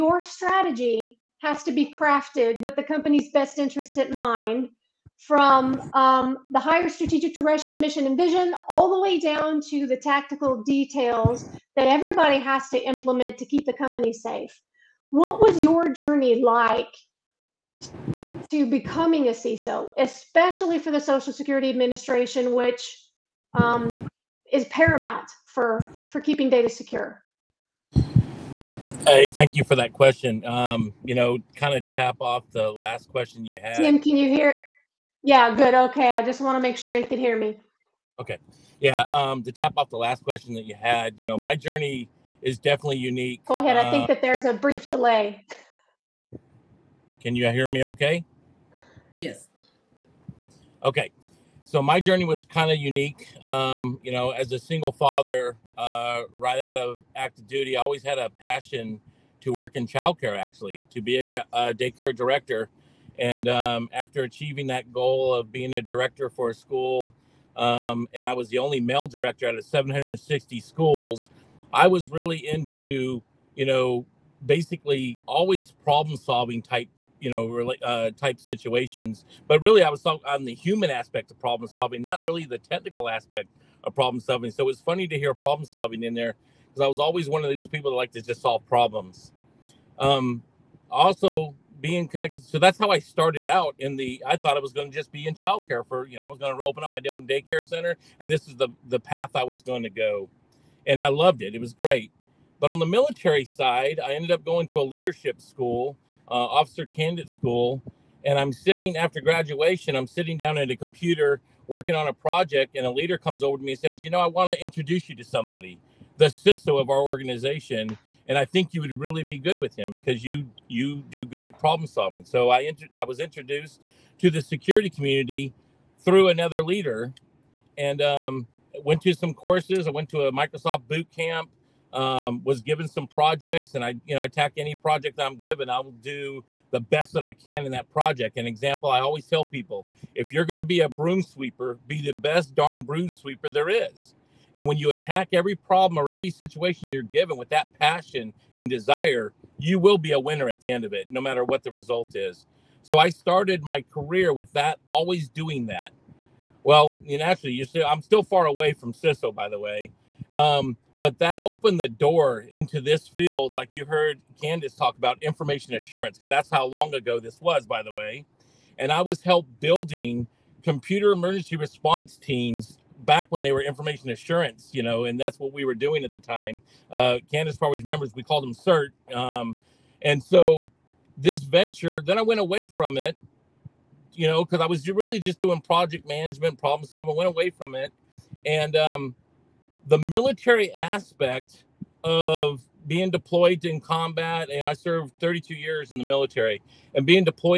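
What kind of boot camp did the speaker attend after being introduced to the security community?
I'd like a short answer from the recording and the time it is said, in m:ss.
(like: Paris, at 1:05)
Microsoft, at 2:10.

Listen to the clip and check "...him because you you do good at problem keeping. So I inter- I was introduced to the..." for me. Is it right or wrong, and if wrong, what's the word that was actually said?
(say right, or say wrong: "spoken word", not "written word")
wrong: "solving", not "keeping".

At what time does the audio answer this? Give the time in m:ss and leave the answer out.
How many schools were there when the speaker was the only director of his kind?
1:09.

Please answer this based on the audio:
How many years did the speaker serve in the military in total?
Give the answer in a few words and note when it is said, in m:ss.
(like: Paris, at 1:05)
32, at 3:15.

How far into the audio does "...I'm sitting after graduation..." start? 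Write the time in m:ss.
1:48.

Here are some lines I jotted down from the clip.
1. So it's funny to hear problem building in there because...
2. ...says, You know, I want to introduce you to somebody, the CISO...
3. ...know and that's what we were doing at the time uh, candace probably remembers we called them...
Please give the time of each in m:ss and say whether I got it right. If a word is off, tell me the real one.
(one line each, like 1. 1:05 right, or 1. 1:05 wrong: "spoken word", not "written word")
1. 1:24 wrong: "solving", not "building"
2. 1:53 right
3. 2:54 right.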